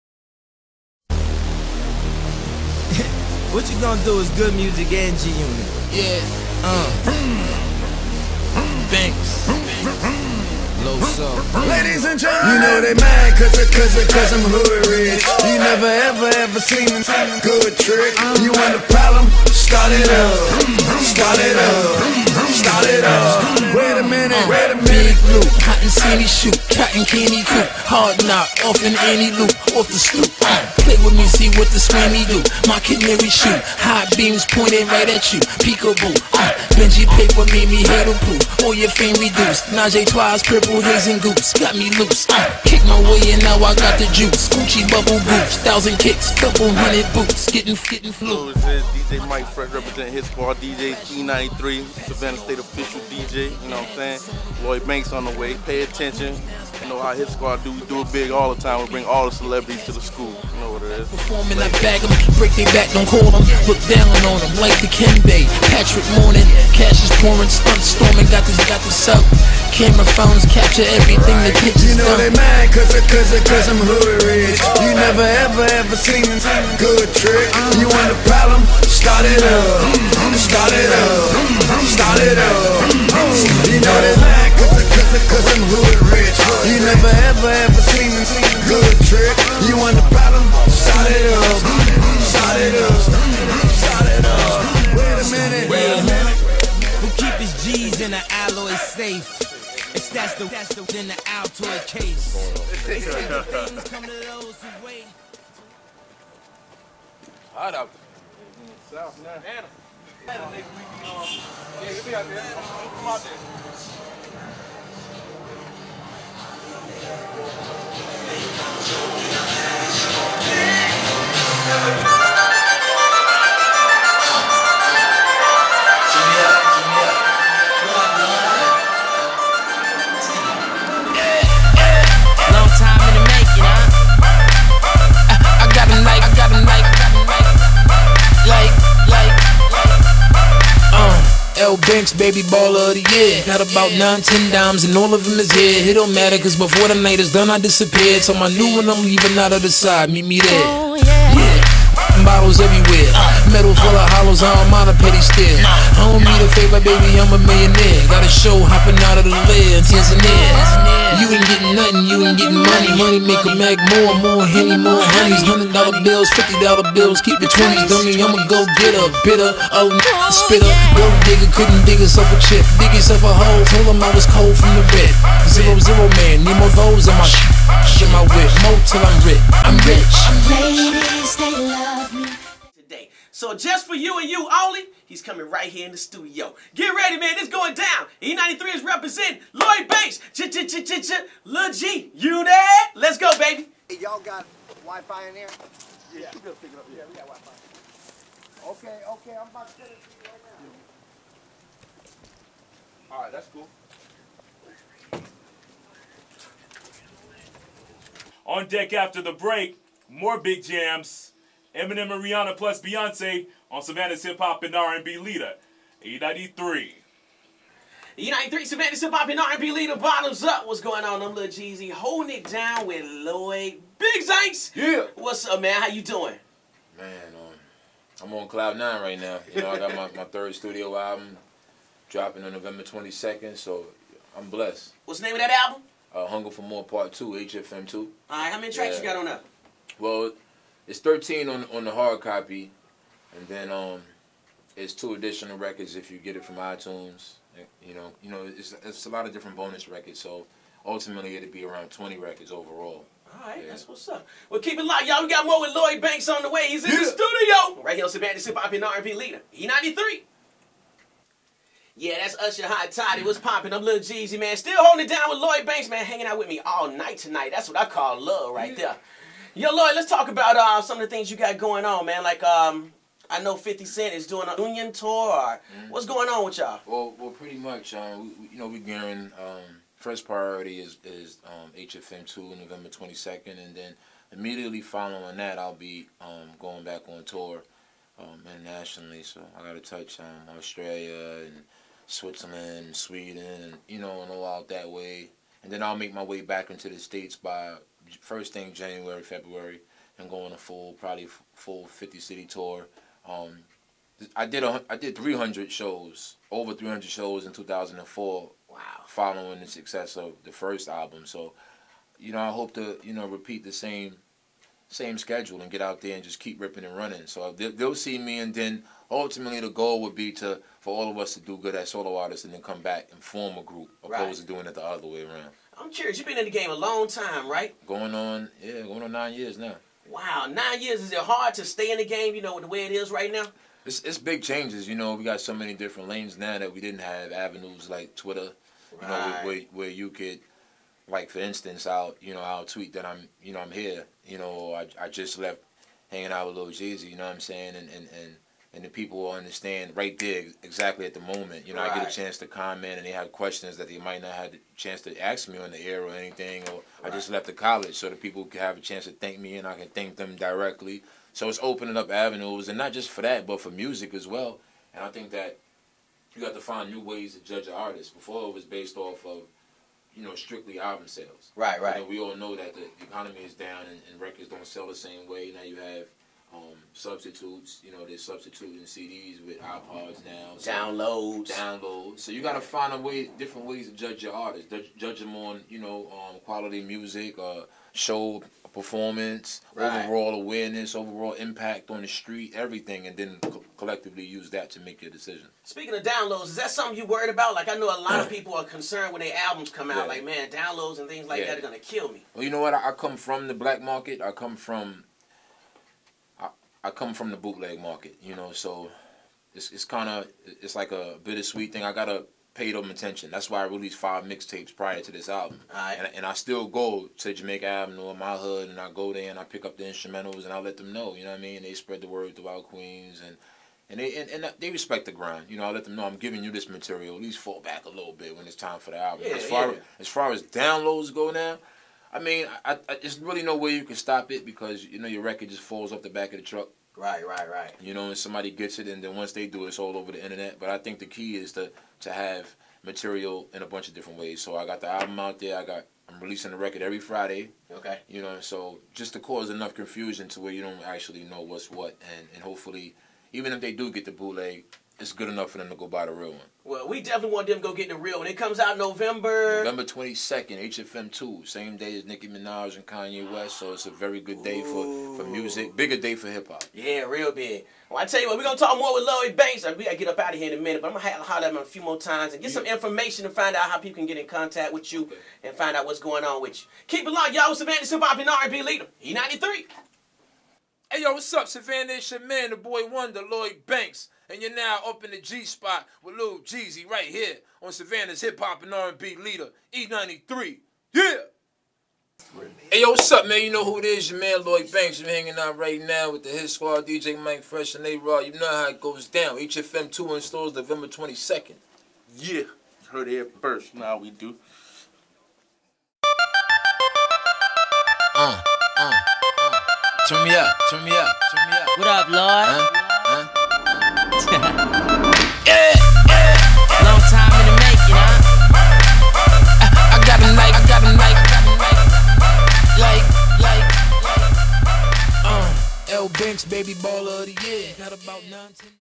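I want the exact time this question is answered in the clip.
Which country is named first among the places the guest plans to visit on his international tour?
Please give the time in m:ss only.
4:50.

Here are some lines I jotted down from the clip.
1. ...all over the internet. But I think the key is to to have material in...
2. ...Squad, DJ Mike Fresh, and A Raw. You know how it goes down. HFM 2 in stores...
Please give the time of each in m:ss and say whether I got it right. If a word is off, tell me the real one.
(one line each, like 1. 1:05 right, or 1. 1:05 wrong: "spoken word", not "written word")
1. 7:19 right
2. 8:16 right.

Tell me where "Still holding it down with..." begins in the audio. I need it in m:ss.
4:24.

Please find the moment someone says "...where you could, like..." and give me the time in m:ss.
5:39.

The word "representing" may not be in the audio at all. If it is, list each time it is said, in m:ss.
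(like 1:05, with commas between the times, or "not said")
0:49, 3:08.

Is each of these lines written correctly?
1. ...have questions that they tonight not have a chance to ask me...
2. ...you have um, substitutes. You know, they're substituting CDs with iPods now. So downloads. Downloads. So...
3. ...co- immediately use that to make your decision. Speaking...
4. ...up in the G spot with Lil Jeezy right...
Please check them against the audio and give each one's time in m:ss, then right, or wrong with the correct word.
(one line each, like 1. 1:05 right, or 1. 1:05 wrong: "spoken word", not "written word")
1. 5:53 wrong: "might", not "tonight"
2. 6:15 right
3. 6:33 wrong: "collectively", not "immediately"
4. 8:04 right.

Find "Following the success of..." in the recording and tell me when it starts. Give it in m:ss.
5:09.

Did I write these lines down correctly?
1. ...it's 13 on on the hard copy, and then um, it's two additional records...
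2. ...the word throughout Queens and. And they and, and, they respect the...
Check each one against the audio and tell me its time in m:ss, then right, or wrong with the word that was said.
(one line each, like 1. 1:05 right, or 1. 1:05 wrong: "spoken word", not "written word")
1. 4:00 right
2. 7:02 right.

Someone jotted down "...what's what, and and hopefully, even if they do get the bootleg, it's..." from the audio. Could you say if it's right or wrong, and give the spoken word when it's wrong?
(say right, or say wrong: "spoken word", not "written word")
right.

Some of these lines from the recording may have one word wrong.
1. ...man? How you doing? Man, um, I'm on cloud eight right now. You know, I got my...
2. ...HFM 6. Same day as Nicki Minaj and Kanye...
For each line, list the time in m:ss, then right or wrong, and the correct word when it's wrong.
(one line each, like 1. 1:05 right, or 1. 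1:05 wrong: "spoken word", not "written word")
1. 3:45 wrong: "nine", not "eight"
2. 7:40 wrong: "2", not "6".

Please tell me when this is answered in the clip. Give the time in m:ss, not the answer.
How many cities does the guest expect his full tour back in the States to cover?
5:01.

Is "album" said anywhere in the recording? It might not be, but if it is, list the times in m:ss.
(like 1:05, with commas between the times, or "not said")
3:50, 3:55, 5:10, 6:10, 6:39, 6:55, 7:08, 7:24.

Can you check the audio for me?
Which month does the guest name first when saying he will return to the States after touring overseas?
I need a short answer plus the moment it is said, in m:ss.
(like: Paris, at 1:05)
January, at 4:58.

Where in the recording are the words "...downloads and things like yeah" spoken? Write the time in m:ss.
6:40.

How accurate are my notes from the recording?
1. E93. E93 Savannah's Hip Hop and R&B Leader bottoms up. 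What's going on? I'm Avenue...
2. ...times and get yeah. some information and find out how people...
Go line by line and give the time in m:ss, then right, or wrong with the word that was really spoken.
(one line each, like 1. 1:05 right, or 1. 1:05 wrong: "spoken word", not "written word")
1. 3:36 wrong: "Lil", not "Avenue"
2. 7:51 right.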